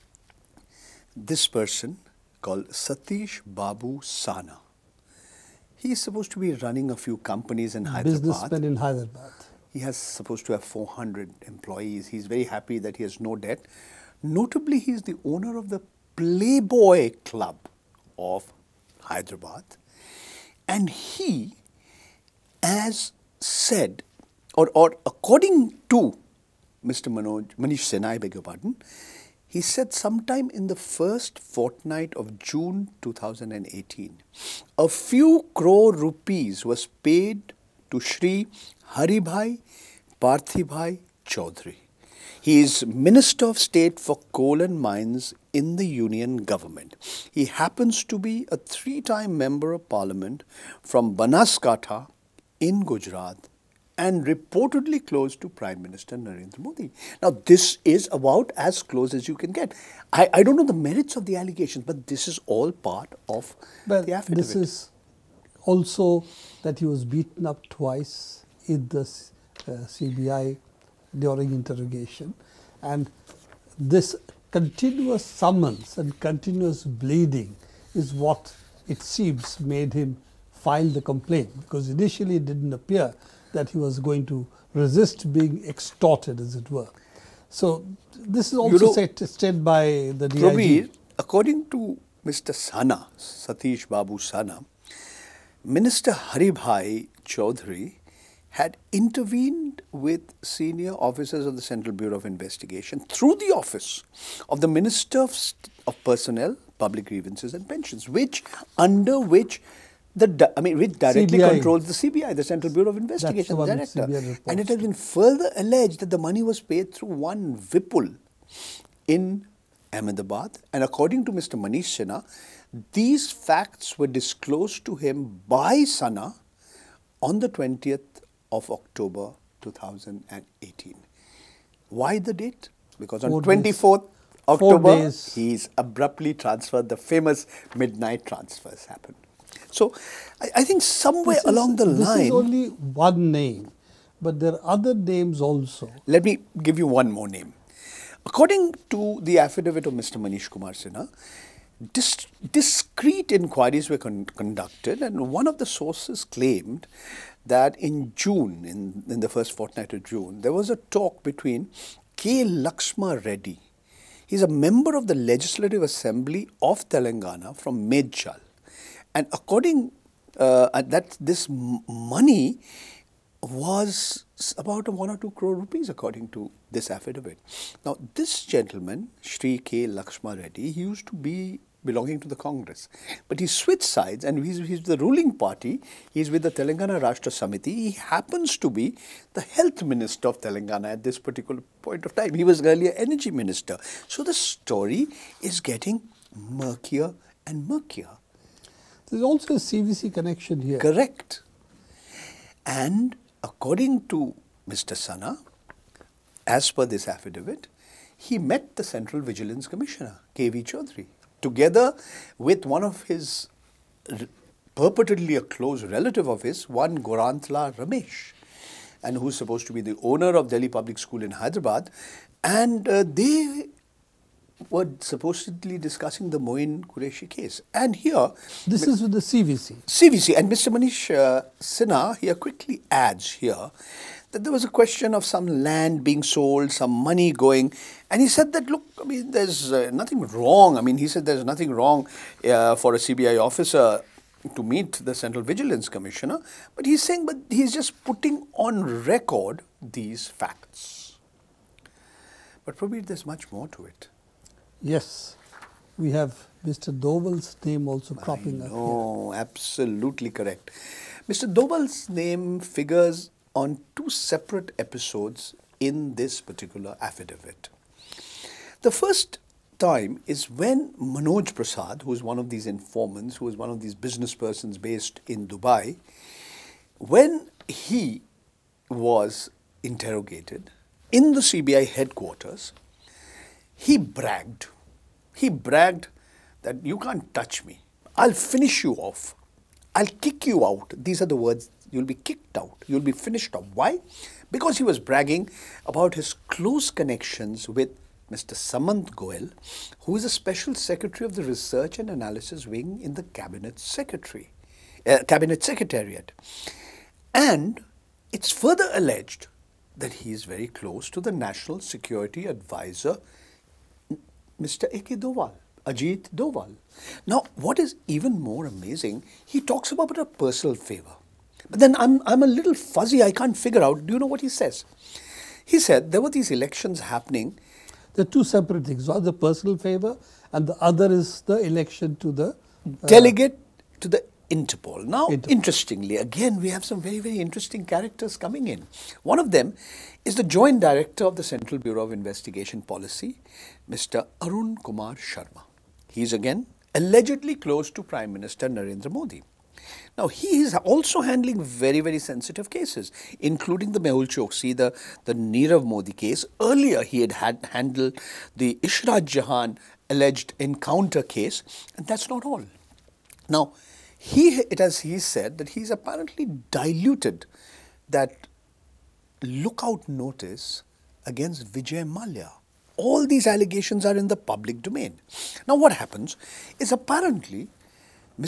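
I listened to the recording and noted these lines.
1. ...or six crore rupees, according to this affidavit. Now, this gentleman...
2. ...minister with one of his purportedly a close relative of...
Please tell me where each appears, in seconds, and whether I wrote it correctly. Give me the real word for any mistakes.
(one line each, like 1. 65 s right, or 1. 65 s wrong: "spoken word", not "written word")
1. 175 s wrong: "two", not "six"
2. 211 s wrong: "together", not "minister".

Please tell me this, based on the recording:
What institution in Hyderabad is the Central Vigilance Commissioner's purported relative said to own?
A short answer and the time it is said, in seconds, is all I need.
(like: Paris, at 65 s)
Delhi Public School, at 220 s.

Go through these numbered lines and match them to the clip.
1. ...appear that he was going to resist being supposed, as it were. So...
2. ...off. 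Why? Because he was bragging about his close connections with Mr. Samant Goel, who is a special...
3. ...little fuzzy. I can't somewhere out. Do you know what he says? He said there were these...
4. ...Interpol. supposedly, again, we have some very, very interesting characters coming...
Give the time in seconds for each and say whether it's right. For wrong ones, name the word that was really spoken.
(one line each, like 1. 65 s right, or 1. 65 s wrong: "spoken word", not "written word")
1. 82 s wrong: "extorted", not "supposed"
2. 293 s right
3. 322 s wrong: "figure", not "somewhere"
4. 335 s wrong: "interestingly", not "supposedly".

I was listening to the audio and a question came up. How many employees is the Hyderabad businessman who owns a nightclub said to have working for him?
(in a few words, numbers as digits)
400.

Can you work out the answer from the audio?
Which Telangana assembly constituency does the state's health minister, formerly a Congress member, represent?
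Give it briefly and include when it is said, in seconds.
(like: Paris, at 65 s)
Medchal, at 167 s.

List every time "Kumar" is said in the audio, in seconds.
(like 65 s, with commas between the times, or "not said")
150 s, 344 s.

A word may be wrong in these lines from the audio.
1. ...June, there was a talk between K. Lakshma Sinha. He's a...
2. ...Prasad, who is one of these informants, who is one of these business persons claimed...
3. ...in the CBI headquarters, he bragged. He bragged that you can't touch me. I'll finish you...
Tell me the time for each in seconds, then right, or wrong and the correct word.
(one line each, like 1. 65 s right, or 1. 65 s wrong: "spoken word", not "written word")
1. 160 s wrong: "Reddy", not "Sinha"
2. 271 s wrong: "based", not "claimed"
3. 281 s right.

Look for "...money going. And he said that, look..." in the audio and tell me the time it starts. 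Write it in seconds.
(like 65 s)
236 s.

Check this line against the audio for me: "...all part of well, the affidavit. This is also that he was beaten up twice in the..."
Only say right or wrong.
right.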